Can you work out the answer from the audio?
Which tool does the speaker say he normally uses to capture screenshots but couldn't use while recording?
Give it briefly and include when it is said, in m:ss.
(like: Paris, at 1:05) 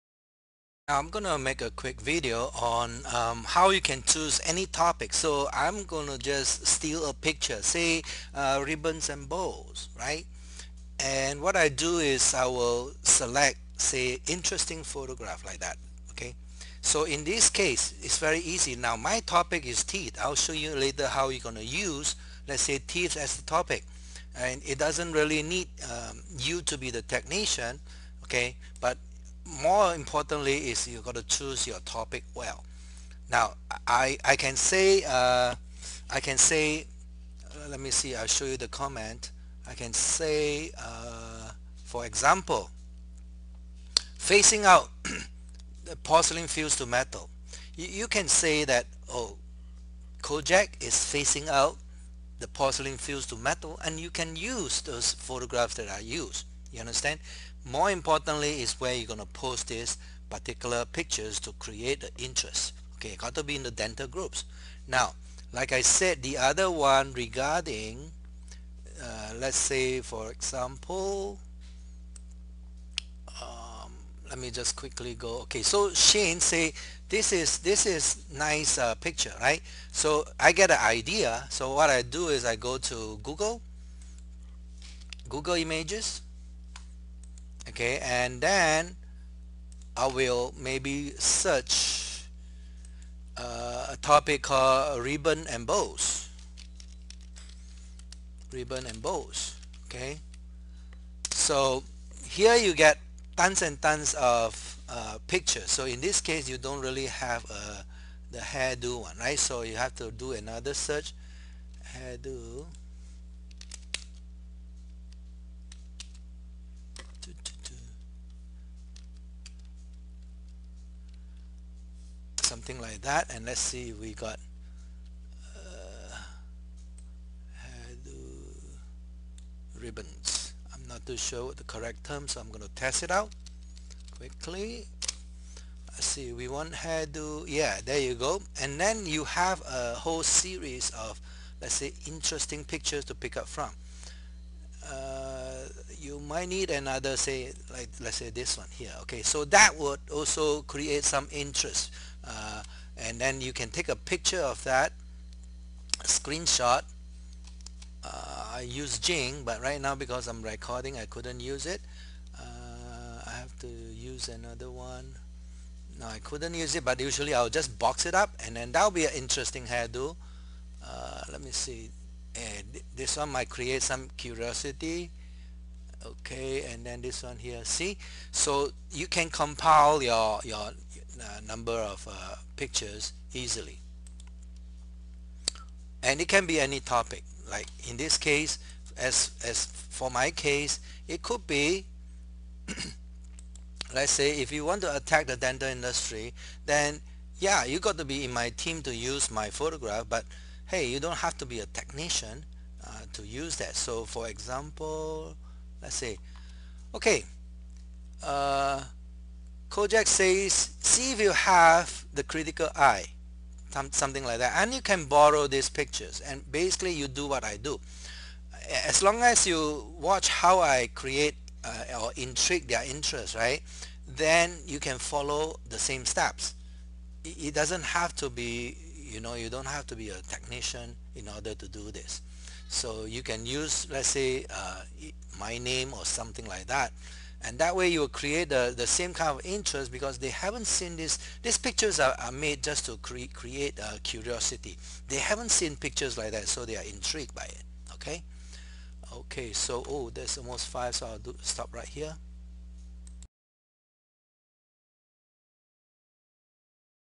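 Jing, at 2:38.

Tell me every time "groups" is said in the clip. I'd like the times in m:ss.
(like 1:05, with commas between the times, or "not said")
1:04.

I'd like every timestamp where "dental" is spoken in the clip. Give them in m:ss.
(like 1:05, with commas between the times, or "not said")
1:03, 3:15.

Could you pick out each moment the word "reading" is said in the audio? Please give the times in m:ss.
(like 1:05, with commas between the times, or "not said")
not said.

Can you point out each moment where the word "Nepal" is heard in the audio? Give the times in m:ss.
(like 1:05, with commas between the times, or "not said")
not said.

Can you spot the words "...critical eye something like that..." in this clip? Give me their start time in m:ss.
3:32.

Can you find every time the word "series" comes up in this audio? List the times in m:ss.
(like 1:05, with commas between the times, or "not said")
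2:20.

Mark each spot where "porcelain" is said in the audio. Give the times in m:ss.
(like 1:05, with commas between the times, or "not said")
0:45, 0:52.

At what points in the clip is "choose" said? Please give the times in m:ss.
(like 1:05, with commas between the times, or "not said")
0:04, 0:31.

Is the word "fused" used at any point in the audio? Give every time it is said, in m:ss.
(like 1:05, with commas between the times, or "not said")
0:46, 0:52.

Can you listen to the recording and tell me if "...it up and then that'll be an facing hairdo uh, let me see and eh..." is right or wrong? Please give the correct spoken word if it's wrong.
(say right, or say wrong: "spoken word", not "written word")
wrong: "interesting", not "facing".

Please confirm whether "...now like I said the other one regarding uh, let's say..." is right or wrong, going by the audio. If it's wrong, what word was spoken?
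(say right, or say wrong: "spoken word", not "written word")
right.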